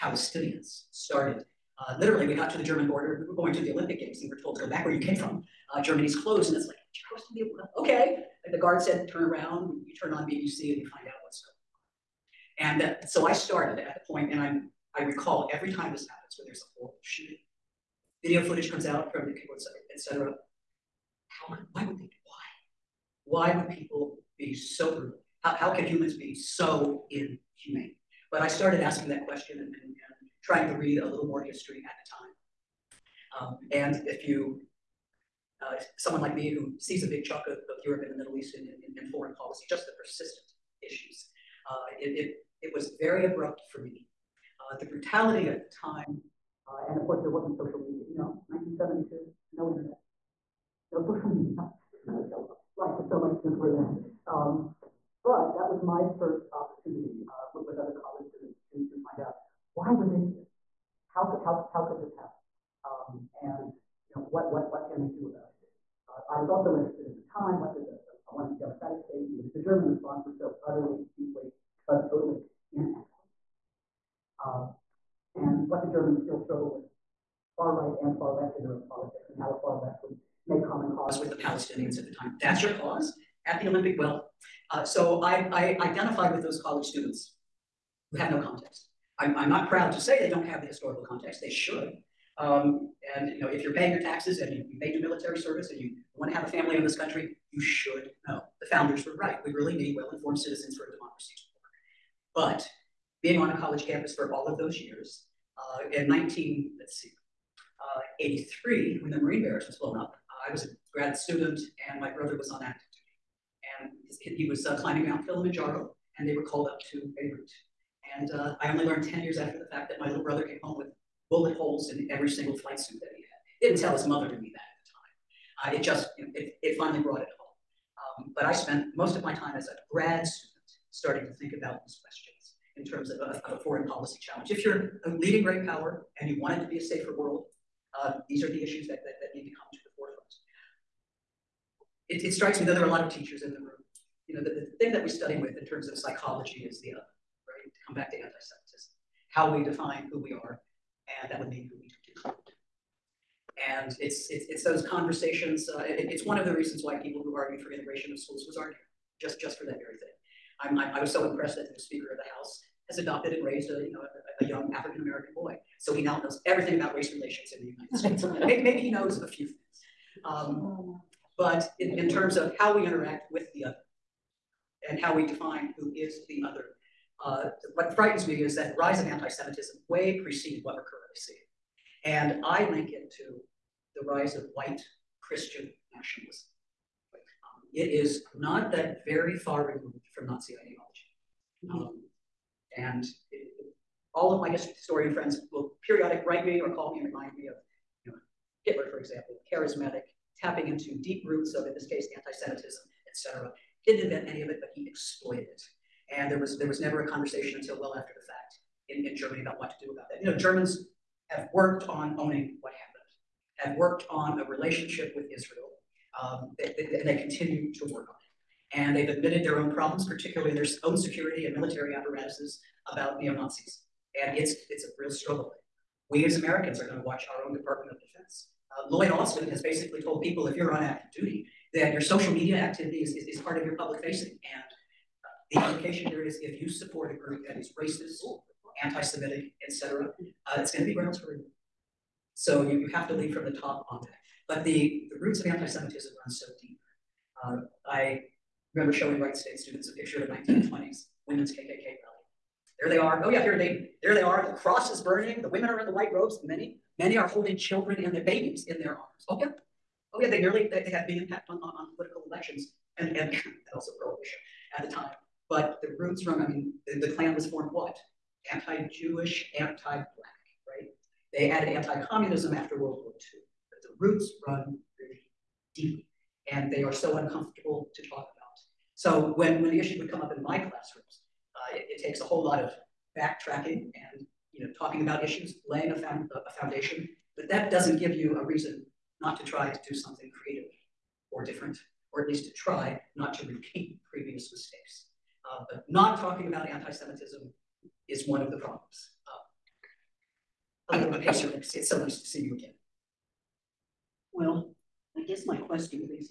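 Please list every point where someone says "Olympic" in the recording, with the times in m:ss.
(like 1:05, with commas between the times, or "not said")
0:03, 1:23.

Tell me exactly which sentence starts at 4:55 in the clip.
Uh, but not talking about anti-Semitism is one of the problems.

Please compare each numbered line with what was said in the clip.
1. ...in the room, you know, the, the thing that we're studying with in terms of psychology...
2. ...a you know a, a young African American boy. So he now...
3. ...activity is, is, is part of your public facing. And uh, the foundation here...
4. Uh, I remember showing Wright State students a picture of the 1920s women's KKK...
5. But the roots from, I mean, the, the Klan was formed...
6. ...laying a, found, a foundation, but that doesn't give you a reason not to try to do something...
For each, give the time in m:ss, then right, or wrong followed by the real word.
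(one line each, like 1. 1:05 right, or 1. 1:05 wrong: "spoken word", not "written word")
1. 2:23 right
2. 2:43 right
3. 3:52 wrong: "implication", not "foundation"
4. 4:07 right
5. 4:25 right
6. 4:45 right.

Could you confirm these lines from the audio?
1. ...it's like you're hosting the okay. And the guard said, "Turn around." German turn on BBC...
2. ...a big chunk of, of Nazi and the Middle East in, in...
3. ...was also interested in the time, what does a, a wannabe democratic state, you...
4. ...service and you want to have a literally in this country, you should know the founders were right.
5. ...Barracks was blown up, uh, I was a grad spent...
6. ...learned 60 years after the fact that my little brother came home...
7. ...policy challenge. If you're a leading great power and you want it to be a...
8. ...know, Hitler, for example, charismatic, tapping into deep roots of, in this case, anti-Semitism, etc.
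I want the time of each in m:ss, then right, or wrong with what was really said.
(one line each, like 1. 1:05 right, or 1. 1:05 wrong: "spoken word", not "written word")
1. 0:06 wrong: "You", not "German"
2. 0:37 wrong: "Europe", not "Nazi"
3. 1:06 right
4. 1:35 wrong: "family", not "literally"
5. 1:49 wrong: "student", not "spent"
6. 1:58 wrong: "10", not "60"
7. 2:13 right
8. 3:18 right.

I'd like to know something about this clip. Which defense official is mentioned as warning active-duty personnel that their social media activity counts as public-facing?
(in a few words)
Lloyd Austin.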